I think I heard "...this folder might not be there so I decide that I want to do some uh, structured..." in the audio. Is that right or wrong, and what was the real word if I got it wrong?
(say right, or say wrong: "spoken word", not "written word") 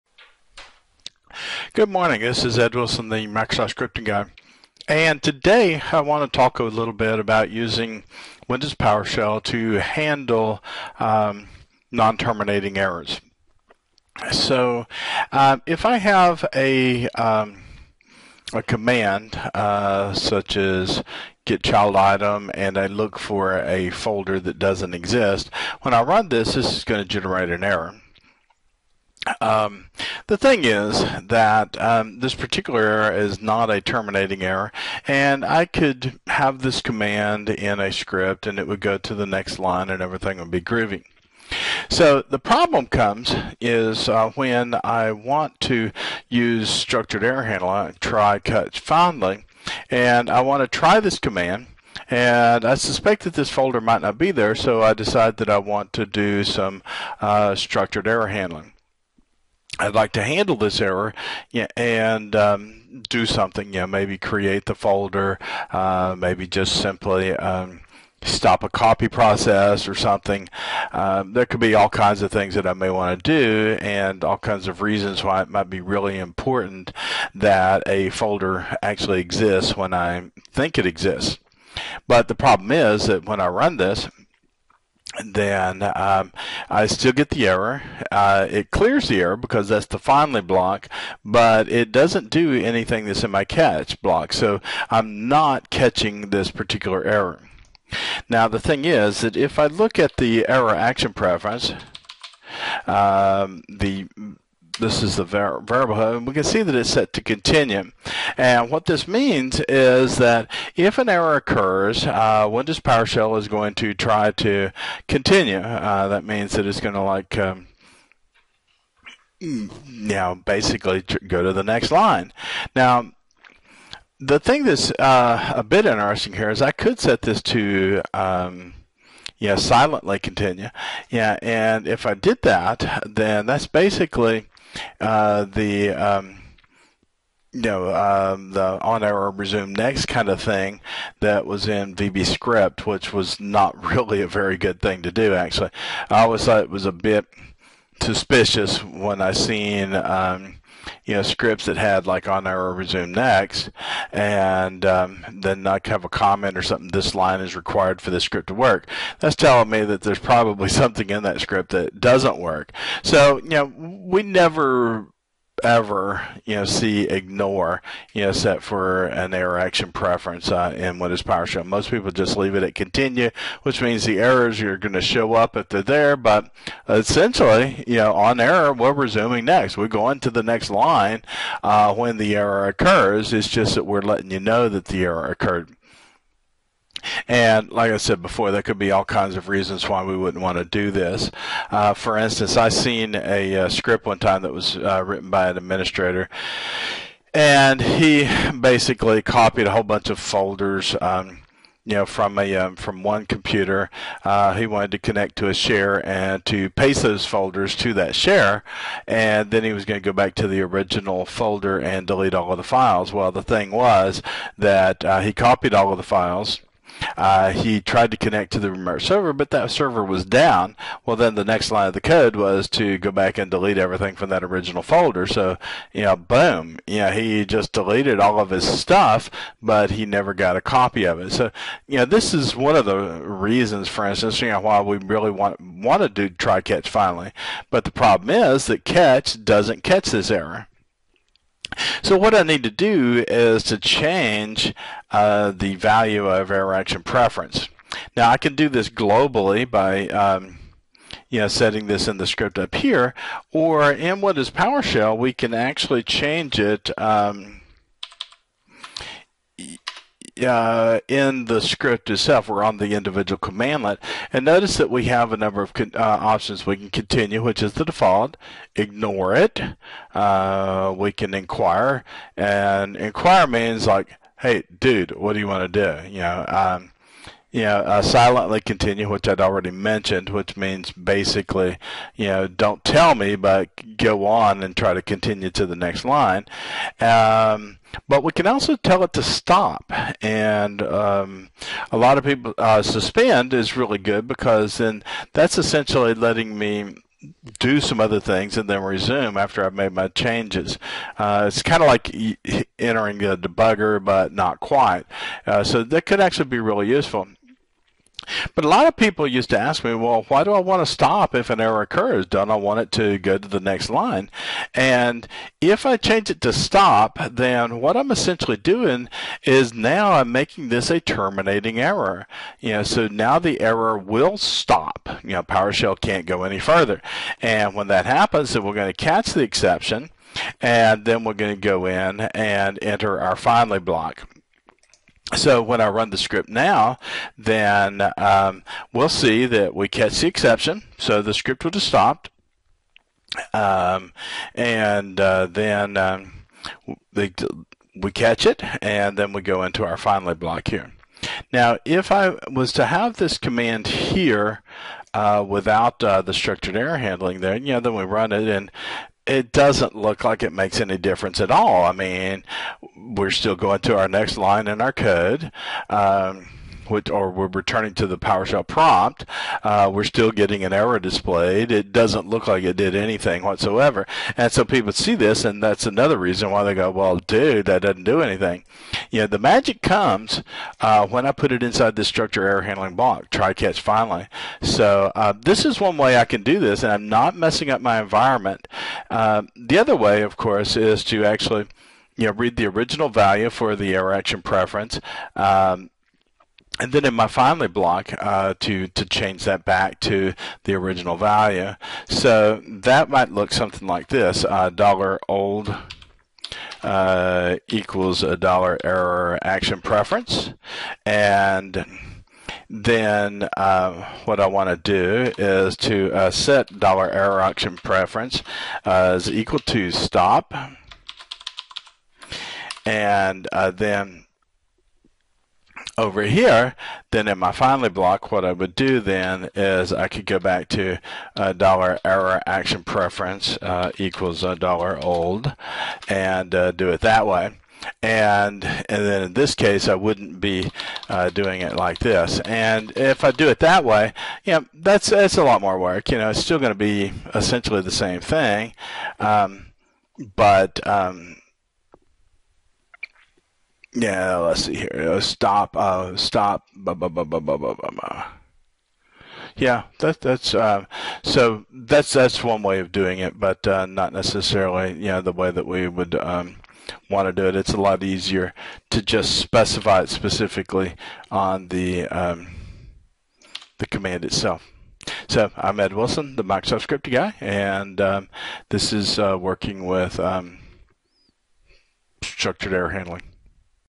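right.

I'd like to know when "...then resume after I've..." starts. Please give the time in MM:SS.
04:58.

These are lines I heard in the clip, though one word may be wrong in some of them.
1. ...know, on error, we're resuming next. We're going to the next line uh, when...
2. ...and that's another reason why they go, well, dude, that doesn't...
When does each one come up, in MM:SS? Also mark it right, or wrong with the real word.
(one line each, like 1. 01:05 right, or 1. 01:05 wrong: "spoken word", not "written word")
1. 02:57 right
2. 06:15 right.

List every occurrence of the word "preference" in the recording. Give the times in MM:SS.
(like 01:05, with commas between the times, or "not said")
01:41, 02:49, 04:07, 06:34, 06:49, 06:57, 07:12.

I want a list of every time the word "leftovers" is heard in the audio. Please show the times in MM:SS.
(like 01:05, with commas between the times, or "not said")
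not said.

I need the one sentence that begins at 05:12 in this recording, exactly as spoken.
Don't I want it to go to the next line?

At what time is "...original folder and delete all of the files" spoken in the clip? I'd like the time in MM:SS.
03:30.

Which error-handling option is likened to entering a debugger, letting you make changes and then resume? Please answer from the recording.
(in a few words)
Suspend.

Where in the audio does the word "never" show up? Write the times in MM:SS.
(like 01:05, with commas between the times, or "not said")
02:44, 03:50.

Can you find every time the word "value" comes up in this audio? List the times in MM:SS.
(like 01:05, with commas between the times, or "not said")
04:05, 06:33, 06:41.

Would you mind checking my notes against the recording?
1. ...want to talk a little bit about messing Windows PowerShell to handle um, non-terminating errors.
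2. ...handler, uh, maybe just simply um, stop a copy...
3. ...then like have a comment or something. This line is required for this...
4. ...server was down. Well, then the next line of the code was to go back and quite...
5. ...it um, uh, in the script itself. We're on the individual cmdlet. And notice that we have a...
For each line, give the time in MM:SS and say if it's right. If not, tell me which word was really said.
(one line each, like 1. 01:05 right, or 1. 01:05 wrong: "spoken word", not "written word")
1. 00:06 wrong: "using", not "messing"
2. 01:04 wrong: "folder", not "handler"
3. 02:35 right
4. 03:39 wrong: "delete", not "quite"
5. 04:16 right.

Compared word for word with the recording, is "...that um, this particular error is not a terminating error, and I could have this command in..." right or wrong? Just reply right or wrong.
right.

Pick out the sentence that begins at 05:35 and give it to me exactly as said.
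So when I run the script now, then um, we'll see that we catch the exception.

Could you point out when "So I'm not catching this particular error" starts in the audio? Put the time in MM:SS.
01:34.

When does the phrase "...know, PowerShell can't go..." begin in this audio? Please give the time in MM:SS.
05:25.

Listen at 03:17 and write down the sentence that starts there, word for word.
And he basically copied a whole bunch of folders, um, you know, from a um, from one computer.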